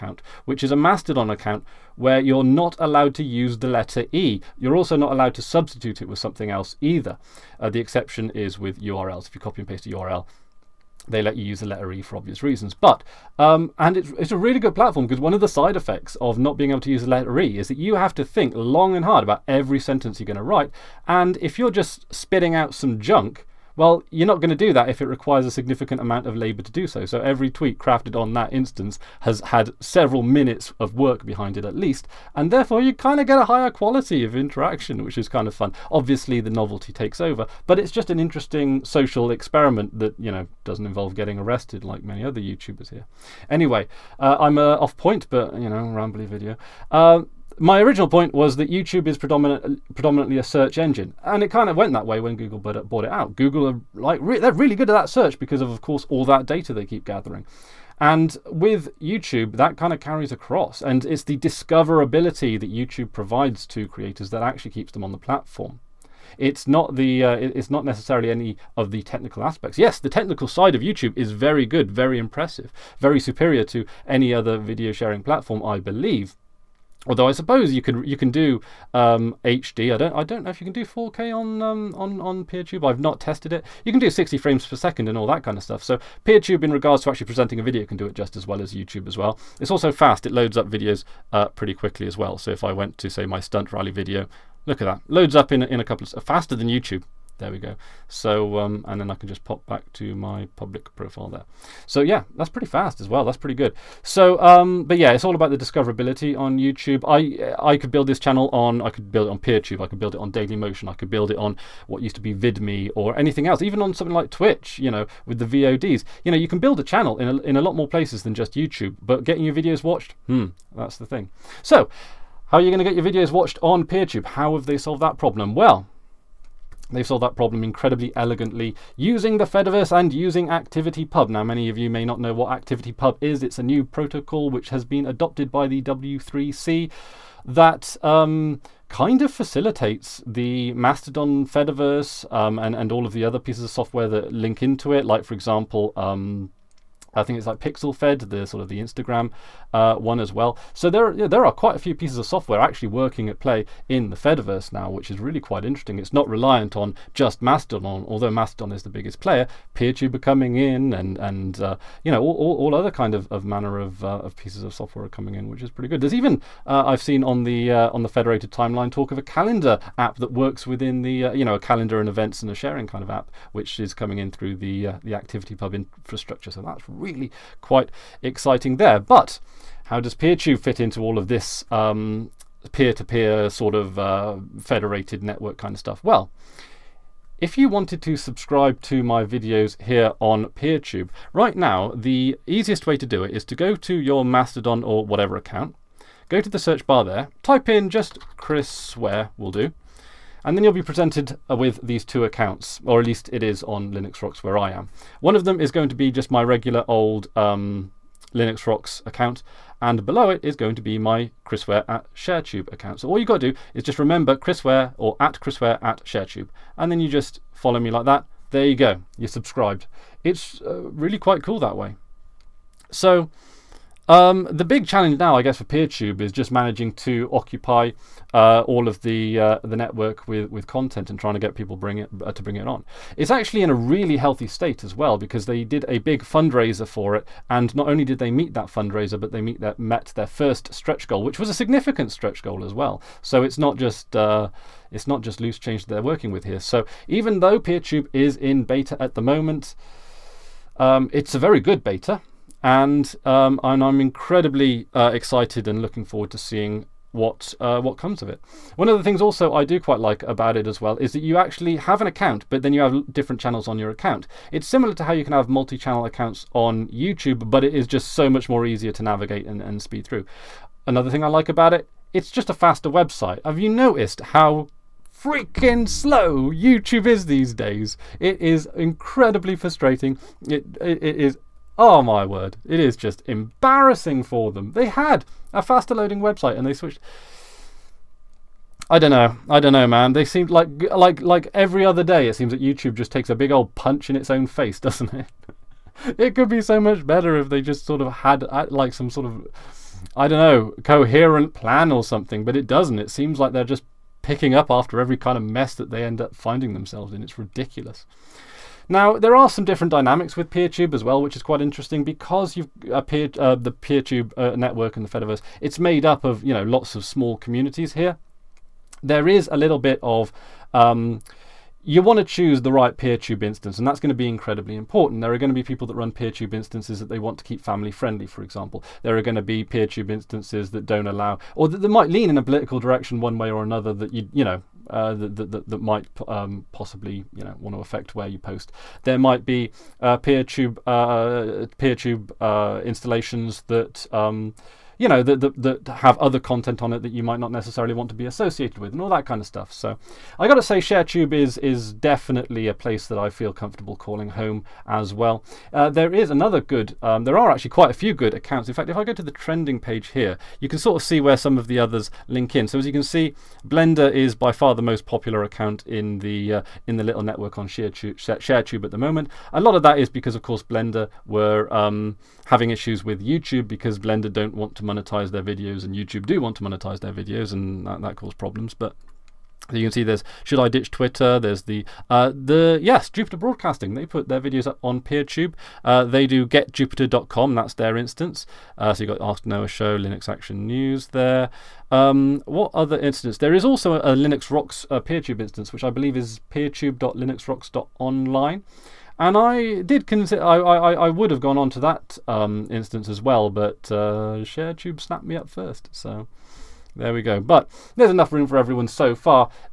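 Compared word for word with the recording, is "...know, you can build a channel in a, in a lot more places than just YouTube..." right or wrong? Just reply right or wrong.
right.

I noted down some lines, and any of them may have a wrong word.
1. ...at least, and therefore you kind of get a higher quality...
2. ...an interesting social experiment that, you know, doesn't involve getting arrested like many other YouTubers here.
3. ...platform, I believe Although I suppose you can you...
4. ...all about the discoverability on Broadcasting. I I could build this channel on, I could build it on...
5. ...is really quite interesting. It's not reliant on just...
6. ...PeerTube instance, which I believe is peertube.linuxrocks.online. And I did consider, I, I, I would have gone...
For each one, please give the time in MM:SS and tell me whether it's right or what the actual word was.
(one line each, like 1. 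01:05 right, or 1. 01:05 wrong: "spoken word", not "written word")
1. 00:31 right
2. 00:38 right
3. 01:15 right
4. 01:45 wrong: "YouTube", not "Broadcasting"
5. 02:35 right
6. 06:34 right.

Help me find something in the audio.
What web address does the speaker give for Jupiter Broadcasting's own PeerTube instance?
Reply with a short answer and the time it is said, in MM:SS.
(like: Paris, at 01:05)
getjupiter.com, at 06:26.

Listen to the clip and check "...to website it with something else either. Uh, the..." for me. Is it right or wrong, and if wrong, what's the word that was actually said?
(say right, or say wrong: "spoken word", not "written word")
wrong: "substitute", not "website".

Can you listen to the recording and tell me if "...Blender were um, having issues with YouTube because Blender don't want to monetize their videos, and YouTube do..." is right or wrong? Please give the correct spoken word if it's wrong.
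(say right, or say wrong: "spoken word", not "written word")
right.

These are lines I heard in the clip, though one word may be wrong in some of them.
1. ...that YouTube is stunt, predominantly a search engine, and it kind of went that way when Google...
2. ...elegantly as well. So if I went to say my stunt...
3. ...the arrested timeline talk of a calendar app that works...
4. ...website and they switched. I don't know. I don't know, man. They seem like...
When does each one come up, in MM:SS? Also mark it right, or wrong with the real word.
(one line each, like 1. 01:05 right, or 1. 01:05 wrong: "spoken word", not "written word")
1. 00:48 wrong: "predominant", not "stunt"
2. 01:31 wrong: "quickly", not "elegantly"
3. 02:48 wrong: "federated", not "arrested"
4. 04:46 right.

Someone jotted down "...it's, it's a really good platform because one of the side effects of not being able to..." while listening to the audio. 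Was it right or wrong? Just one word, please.
right.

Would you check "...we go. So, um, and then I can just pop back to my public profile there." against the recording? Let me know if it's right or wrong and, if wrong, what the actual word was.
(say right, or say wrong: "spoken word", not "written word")
right.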